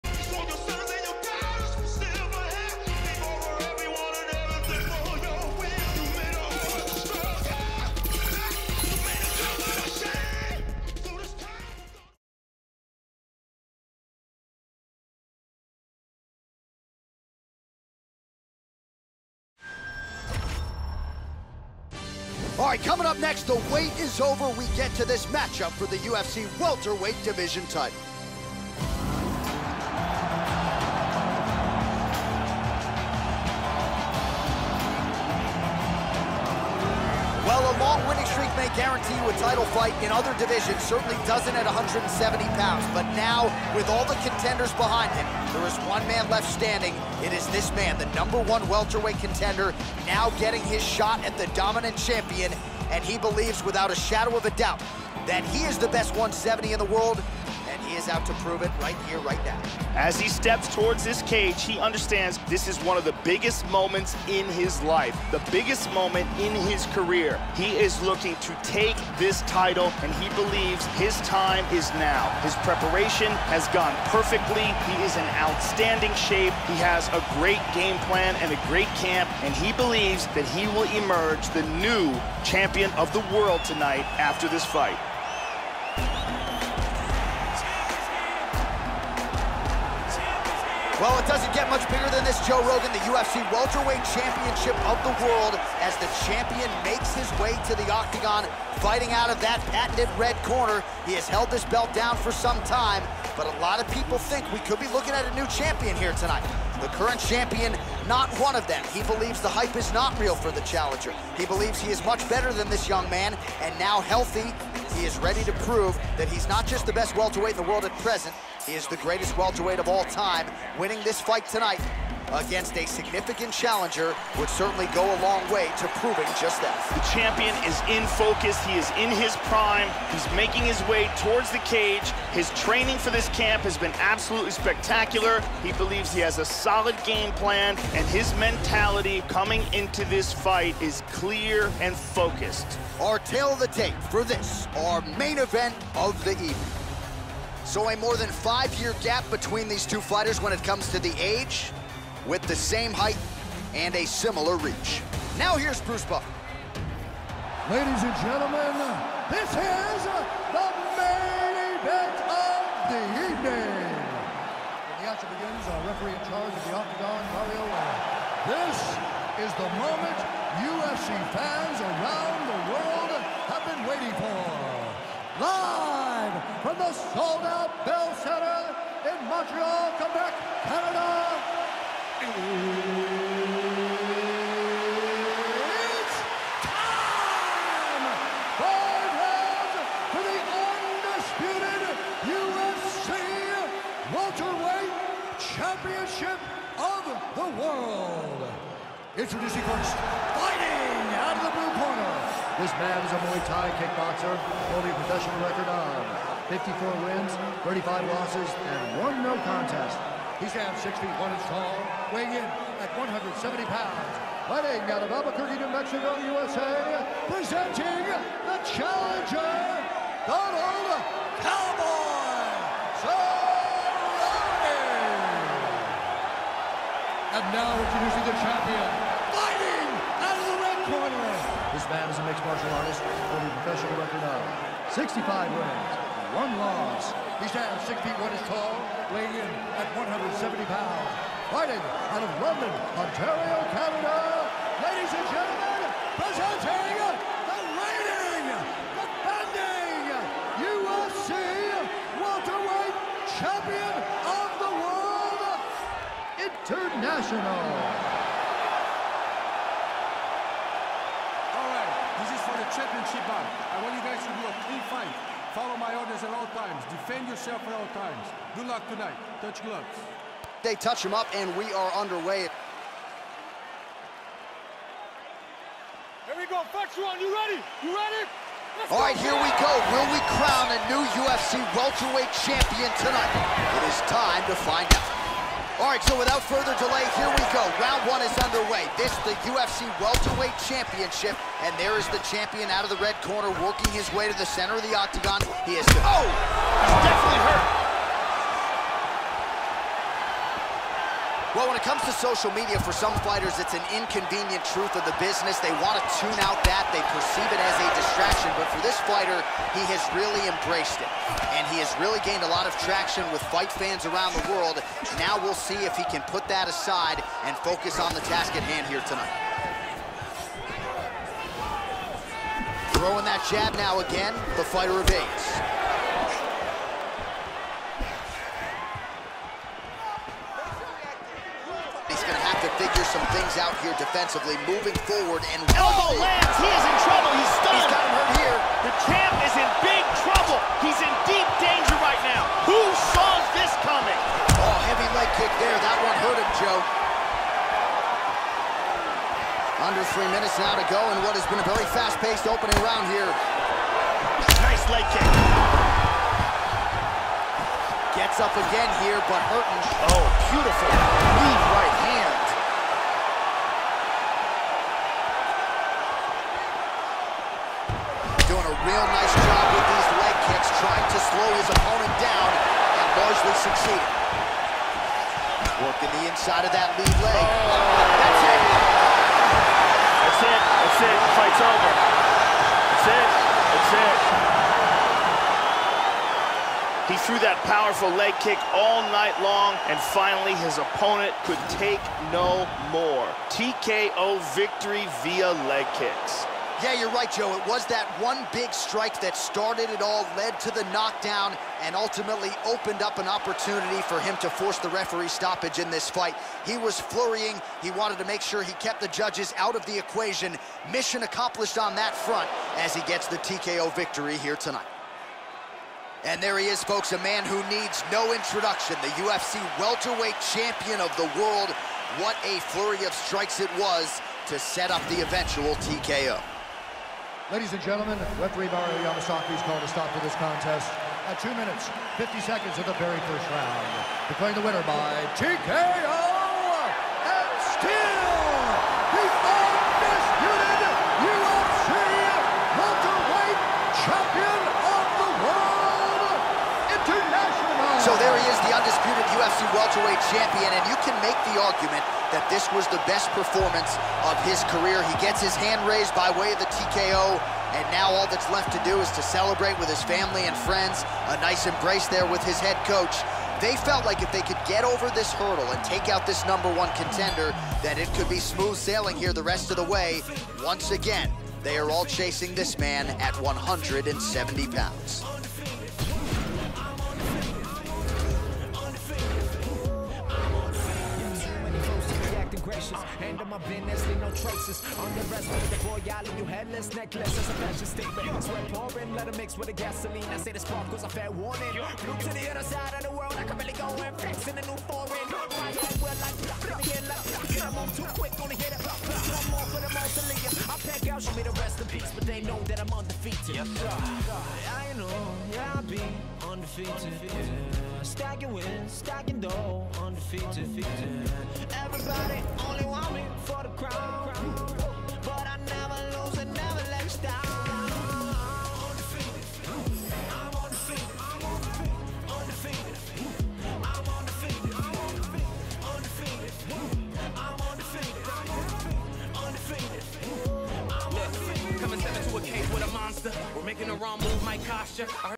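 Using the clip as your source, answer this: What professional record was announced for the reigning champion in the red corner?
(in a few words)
65 wins, 1 loss.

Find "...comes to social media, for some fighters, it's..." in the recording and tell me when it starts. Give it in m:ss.
5:01.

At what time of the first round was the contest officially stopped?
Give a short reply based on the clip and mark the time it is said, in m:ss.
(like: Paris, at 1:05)
2:50, at 7:11.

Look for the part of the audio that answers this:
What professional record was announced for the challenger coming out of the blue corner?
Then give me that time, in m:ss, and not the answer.
3:26.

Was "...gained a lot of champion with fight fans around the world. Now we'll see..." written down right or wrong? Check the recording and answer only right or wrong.
wrong.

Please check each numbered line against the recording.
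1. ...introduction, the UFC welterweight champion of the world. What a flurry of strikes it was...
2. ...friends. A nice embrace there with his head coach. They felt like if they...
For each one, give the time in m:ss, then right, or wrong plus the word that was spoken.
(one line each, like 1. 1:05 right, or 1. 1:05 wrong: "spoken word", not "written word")
1. 6:58 right
2. 7:40 right.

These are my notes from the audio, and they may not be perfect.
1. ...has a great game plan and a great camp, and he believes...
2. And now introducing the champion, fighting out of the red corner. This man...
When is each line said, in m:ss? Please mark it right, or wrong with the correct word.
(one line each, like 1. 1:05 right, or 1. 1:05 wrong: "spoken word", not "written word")
1. 1:16 right
2. 3:47 right.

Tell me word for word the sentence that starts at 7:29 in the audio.
undisputed UFC welterweight champion, and you can make the argument that this was the best performance of his career.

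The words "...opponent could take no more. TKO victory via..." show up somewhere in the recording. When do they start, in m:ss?
6:30.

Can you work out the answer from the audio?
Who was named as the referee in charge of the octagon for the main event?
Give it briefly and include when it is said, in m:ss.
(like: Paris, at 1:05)
Mario Lane, at 2:47.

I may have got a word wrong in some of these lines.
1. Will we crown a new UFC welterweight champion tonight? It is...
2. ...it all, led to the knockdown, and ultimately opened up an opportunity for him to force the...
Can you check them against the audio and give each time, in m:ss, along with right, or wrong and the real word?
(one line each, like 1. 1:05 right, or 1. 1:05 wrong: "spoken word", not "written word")
1. 4:39 right
2. 6:39 right.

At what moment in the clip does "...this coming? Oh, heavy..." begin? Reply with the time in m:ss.
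5:43.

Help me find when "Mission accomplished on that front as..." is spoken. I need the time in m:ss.
6:50.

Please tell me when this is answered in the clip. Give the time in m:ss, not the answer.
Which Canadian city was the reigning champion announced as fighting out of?
4:02.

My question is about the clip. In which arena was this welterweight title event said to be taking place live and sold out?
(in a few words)
Bell Center.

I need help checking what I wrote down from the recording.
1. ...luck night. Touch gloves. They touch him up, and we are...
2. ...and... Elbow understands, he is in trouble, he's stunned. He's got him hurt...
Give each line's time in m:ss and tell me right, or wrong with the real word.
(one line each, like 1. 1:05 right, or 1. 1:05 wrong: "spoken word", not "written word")
1. 4:28 wrong: "tonight", not "night"
2. 5:35 wrong: "lands", not "understands".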